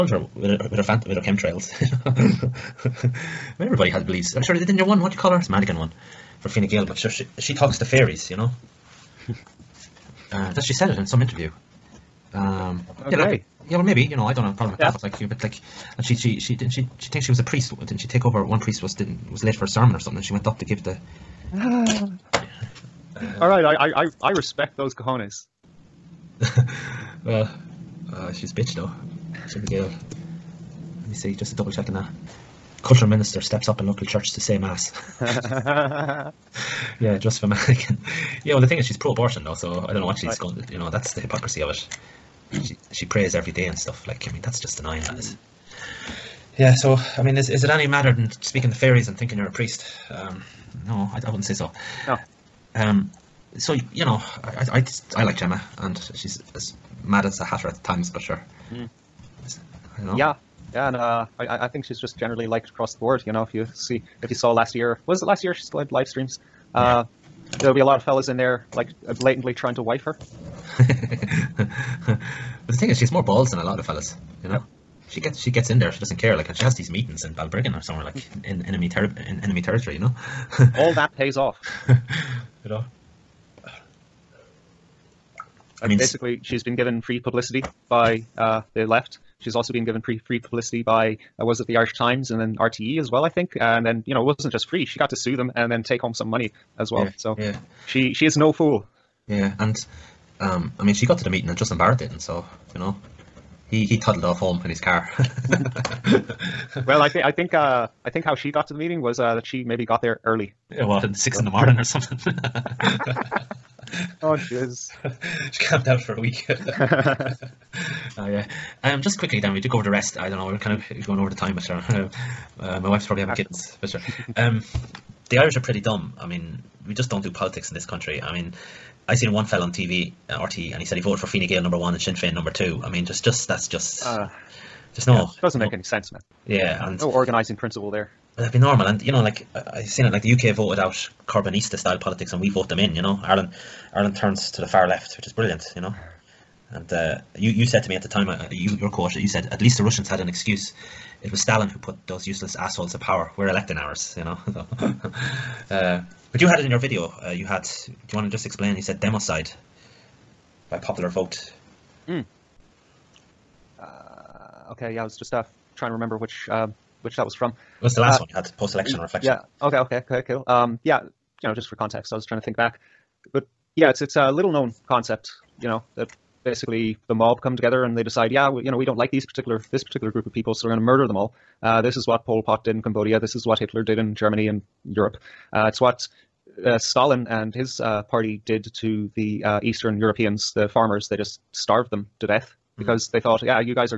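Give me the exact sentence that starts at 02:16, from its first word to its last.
Yeah, and no organizing principle there.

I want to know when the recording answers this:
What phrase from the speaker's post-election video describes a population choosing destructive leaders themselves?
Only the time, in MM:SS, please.
02:39.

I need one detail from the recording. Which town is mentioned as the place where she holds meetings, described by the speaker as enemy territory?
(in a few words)
Balbriggan.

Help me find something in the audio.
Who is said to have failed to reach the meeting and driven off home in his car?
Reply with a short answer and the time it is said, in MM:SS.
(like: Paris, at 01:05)
Justin Barrett, at 01:41.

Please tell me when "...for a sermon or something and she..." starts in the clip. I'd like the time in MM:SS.
00:19.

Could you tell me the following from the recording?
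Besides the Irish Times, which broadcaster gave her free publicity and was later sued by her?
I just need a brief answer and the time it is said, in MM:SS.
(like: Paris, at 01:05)
RTE, at 01:32.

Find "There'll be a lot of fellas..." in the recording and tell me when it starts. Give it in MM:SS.
01:07.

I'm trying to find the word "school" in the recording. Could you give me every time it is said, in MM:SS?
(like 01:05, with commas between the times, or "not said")
not said.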